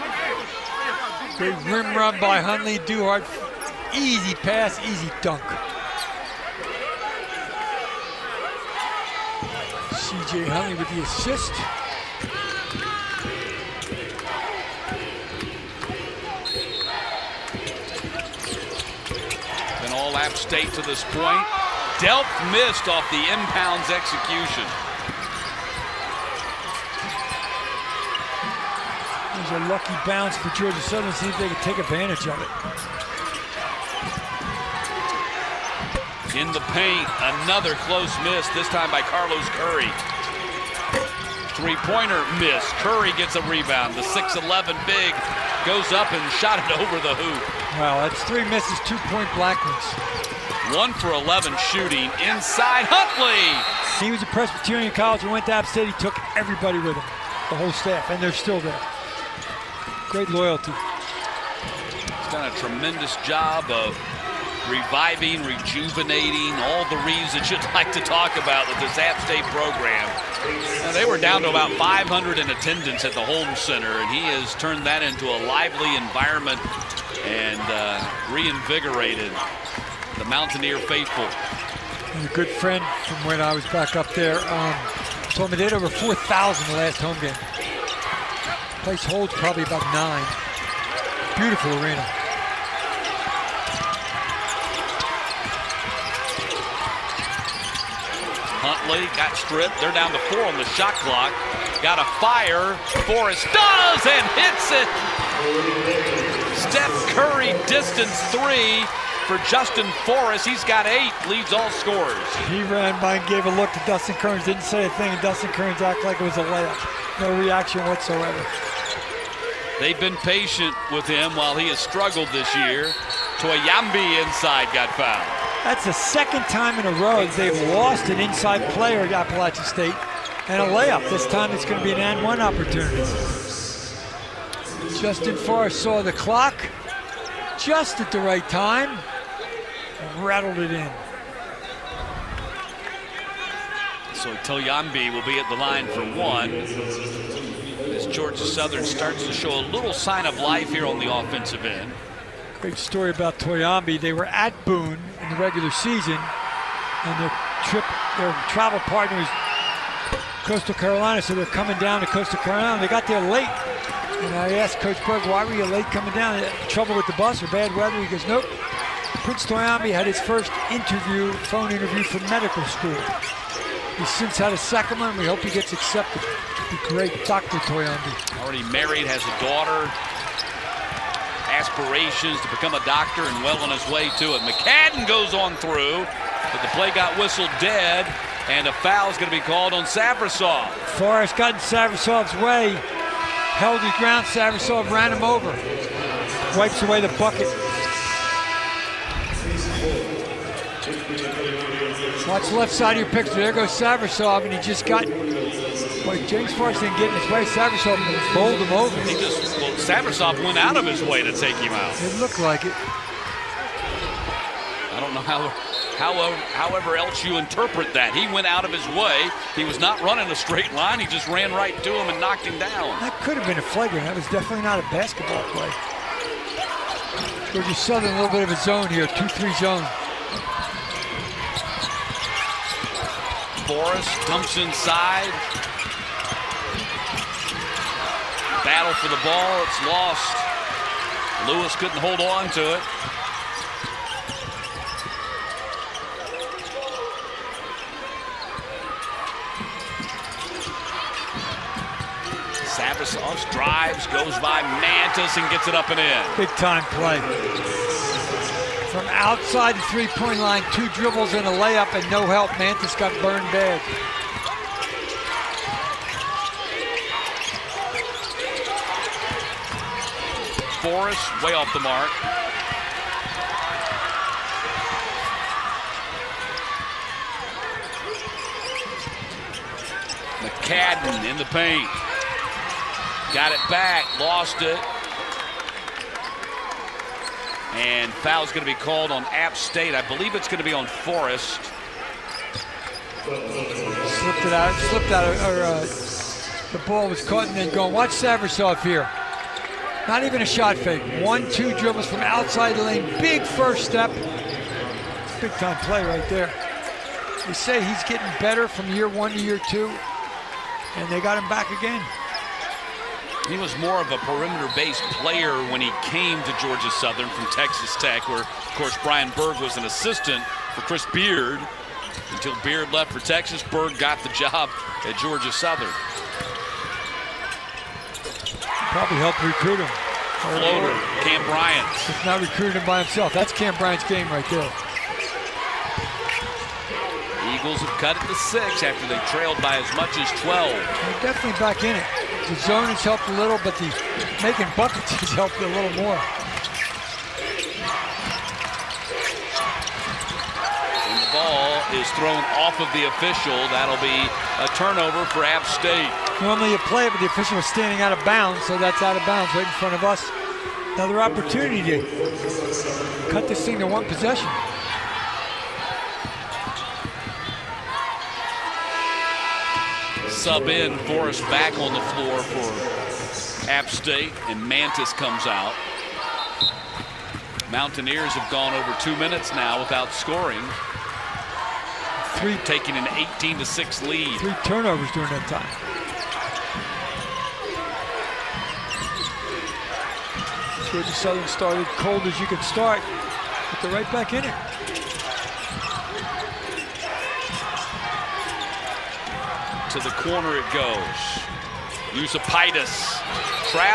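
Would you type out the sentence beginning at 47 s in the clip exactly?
Well, that's three misses, two-point Blackwood's.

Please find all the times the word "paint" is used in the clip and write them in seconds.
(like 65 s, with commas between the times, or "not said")
36 s, 281 s.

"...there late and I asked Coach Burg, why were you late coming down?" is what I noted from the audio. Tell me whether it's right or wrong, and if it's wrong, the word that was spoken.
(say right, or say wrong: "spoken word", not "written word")
right.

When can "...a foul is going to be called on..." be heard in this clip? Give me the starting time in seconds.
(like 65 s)
188 s.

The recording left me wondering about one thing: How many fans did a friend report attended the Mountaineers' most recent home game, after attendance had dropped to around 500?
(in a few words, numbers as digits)
over 4,000.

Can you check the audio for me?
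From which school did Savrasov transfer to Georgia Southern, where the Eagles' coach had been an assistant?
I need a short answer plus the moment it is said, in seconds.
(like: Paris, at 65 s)
Texas Tech, at 317 s.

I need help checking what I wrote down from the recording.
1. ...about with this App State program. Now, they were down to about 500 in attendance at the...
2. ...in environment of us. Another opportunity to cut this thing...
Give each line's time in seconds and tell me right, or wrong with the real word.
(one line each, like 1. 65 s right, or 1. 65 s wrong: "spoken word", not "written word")
1. 68 s right
2. 359 s wrong: "front", not "environment".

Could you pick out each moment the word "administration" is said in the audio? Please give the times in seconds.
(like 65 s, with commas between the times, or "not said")
not said.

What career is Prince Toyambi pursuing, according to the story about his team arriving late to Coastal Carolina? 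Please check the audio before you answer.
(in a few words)
doctor.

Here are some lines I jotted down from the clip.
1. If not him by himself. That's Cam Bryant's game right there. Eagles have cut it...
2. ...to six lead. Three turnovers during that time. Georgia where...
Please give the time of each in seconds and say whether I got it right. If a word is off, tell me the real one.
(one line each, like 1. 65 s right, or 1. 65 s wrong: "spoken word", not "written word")
1. 332 s right
2. 383 s right.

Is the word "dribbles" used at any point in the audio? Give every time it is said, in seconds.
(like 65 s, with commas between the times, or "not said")
260 s, 301 s.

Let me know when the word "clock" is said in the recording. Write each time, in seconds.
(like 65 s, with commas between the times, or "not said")
101 s, 136 s.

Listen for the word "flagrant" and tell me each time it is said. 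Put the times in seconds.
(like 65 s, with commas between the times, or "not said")
223 s.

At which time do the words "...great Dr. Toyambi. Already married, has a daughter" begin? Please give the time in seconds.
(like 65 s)
176 s.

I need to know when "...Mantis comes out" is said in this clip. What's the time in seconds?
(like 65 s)
374 s.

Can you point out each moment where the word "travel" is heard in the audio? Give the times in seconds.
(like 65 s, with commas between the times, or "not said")
158 s.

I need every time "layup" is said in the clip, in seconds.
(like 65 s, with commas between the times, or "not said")
116 s, 130 s, 261 s.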